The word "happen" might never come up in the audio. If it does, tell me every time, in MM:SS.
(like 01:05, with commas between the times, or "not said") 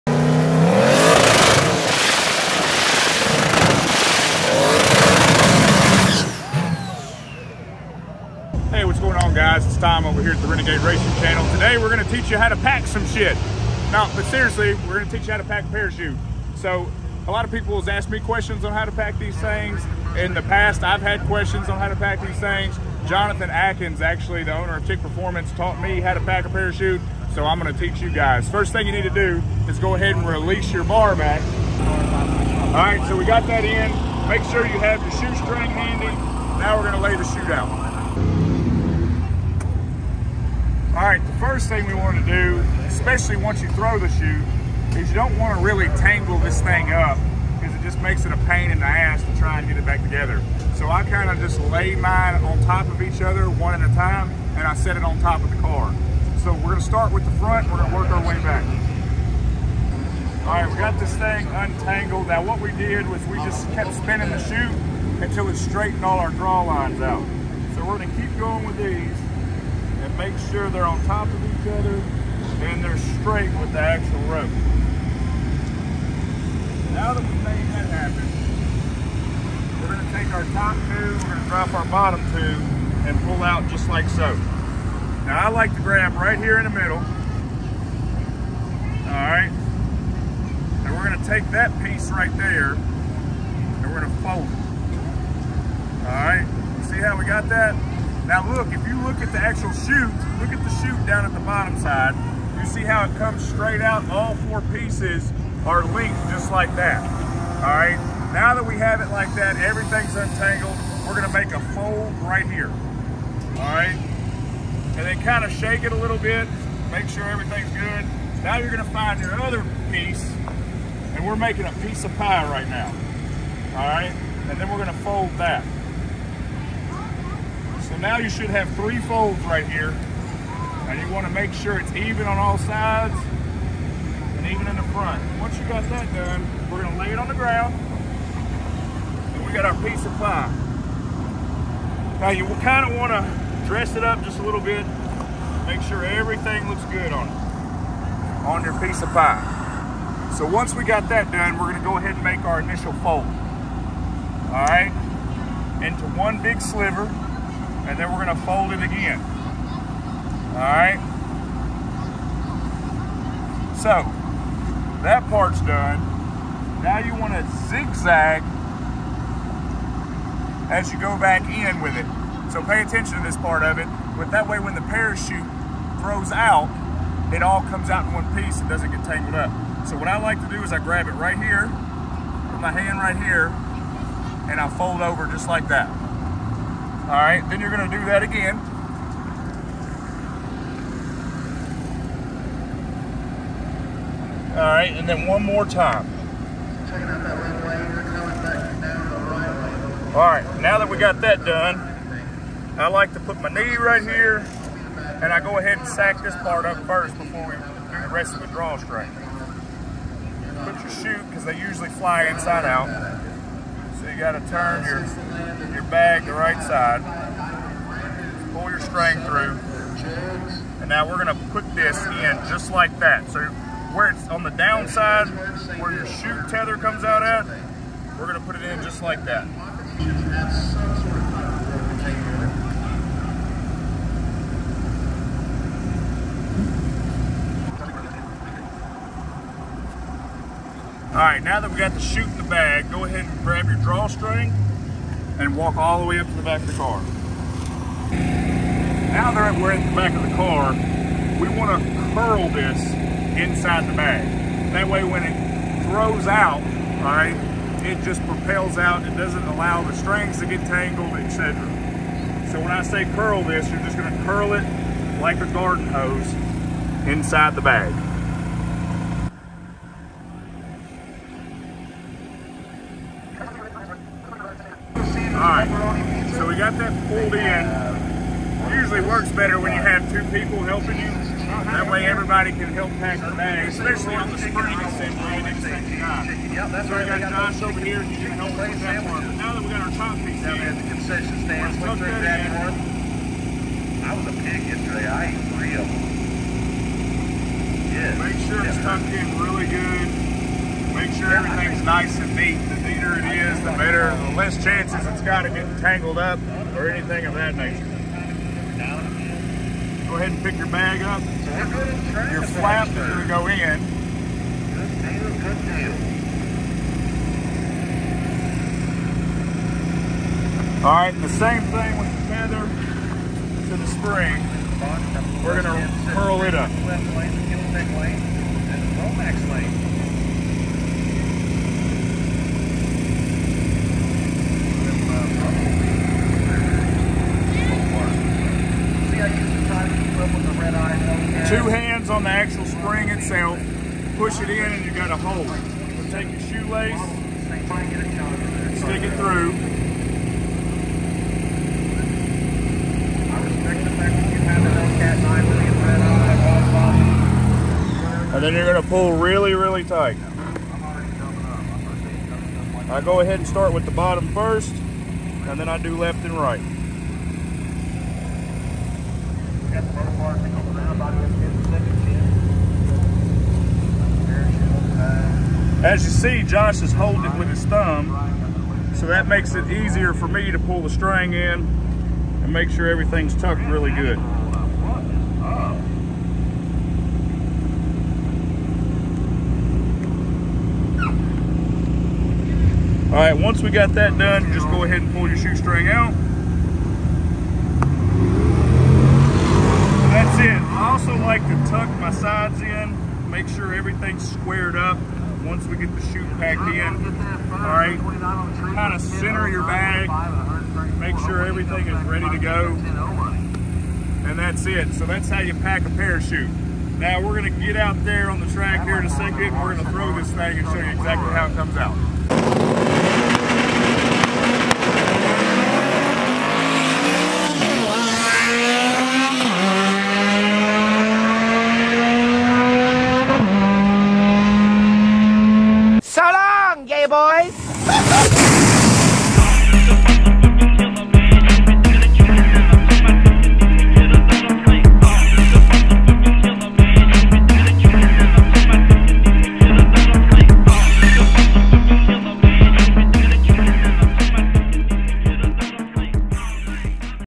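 01:17.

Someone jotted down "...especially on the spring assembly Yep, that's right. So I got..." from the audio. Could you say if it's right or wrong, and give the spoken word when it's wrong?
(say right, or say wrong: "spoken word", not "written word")
right.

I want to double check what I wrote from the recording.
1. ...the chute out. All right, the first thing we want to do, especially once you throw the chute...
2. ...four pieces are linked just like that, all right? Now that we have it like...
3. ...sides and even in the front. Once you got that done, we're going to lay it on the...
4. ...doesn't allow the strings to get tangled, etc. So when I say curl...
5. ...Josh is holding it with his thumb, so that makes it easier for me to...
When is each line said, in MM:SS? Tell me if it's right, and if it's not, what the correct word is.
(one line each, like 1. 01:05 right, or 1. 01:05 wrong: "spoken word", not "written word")
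1. 00:37 right
2. 01:44 right
3. 02:12 right
4. 04:19 right
5. 06:16 right.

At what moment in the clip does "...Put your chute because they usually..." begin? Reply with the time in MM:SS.
03:28.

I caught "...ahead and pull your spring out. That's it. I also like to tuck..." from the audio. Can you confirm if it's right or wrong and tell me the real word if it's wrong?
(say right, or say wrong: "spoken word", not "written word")
wrong: "shoestring", not "spring".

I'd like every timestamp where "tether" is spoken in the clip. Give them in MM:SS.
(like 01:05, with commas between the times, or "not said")
03:46.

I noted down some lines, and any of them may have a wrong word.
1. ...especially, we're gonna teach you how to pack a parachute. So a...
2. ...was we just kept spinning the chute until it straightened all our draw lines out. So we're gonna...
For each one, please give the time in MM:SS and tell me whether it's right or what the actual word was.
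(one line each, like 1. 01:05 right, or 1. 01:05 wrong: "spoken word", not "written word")
1. 00:14 wrong: "seriously", not "especially"
2. 01:03 right.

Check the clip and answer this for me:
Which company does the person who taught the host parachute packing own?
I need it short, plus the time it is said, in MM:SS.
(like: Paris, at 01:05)
Tick Performance, at 00:24.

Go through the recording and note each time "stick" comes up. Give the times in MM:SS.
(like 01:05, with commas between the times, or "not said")
05:48.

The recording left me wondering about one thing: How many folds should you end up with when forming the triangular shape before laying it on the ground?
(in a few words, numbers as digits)
3.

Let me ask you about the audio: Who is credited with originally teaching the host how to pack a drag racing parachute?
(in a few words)
Jonathan Atkins.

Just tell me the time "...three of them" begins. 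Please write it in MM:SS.
04:55.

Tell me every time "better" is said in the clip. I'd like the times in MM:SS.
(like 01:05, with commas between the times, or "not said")
04:39, 05:03.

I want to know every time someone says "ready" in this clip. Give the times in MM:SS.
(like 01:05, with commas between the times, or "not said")
06:52.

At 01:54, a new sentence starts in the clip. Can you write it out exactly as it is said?
And then kind of shake it a little bit, make sure everything's good.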